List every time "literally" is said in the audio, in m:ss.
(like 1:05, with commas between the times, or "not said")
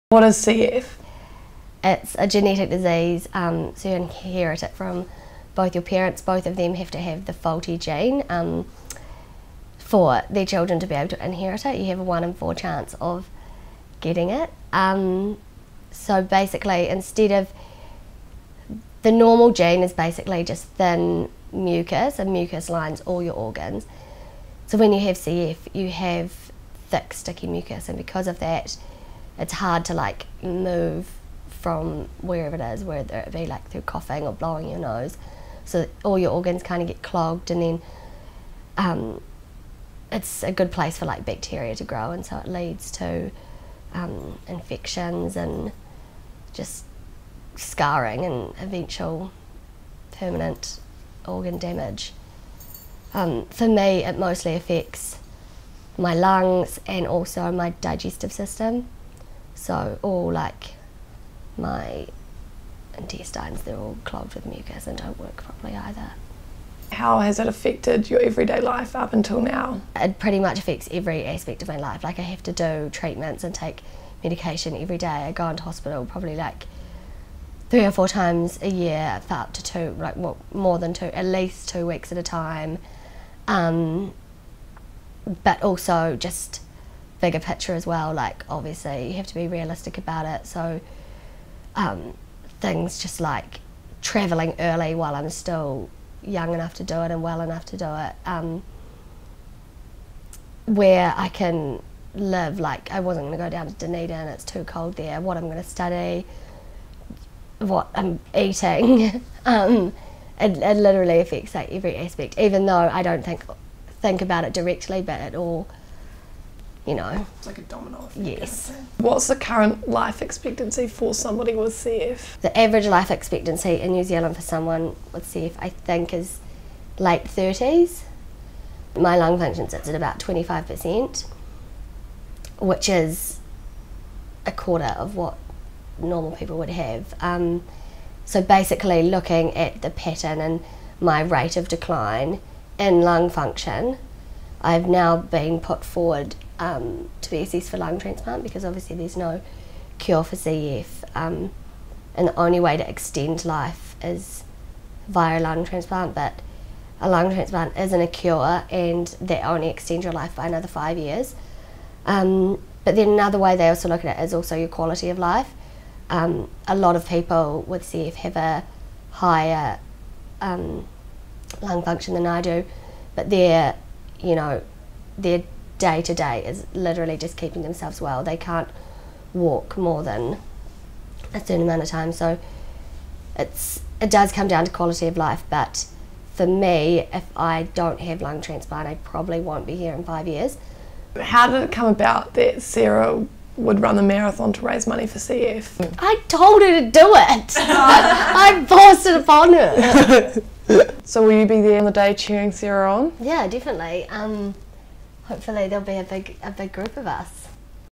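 1:50, 2:56.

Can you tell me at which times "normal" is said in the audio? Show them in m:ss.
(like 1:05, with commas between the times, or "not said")
0:19, 2:15.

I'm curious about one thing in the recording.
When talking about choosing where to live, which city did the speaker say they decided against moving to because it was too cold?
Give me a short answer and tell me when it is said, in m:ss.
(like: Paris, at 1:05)
Dunedin, at 1:43.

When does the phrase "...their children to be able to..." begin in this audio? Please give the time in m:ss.
0:10.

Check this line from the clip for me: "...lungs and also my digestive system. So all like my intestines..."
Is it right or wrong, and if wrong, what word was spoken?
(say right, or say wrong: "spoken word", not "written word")
right.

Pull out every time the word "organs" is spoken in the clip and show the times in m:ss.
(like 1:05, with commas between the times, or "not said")
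0:23, 0:36, 0:51.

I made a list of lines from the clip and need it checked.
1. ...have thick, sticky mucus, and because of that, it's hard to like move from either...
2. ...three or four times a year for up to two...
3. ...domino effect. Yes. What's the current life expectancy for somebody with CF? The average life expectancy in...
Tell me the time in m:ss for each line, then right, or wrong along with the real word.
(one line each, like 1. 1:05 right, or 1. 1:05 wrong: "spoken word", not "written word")
1. 0:25 wrong: "wherever", not "either"
2. 1:17 right
3. 1:57 right.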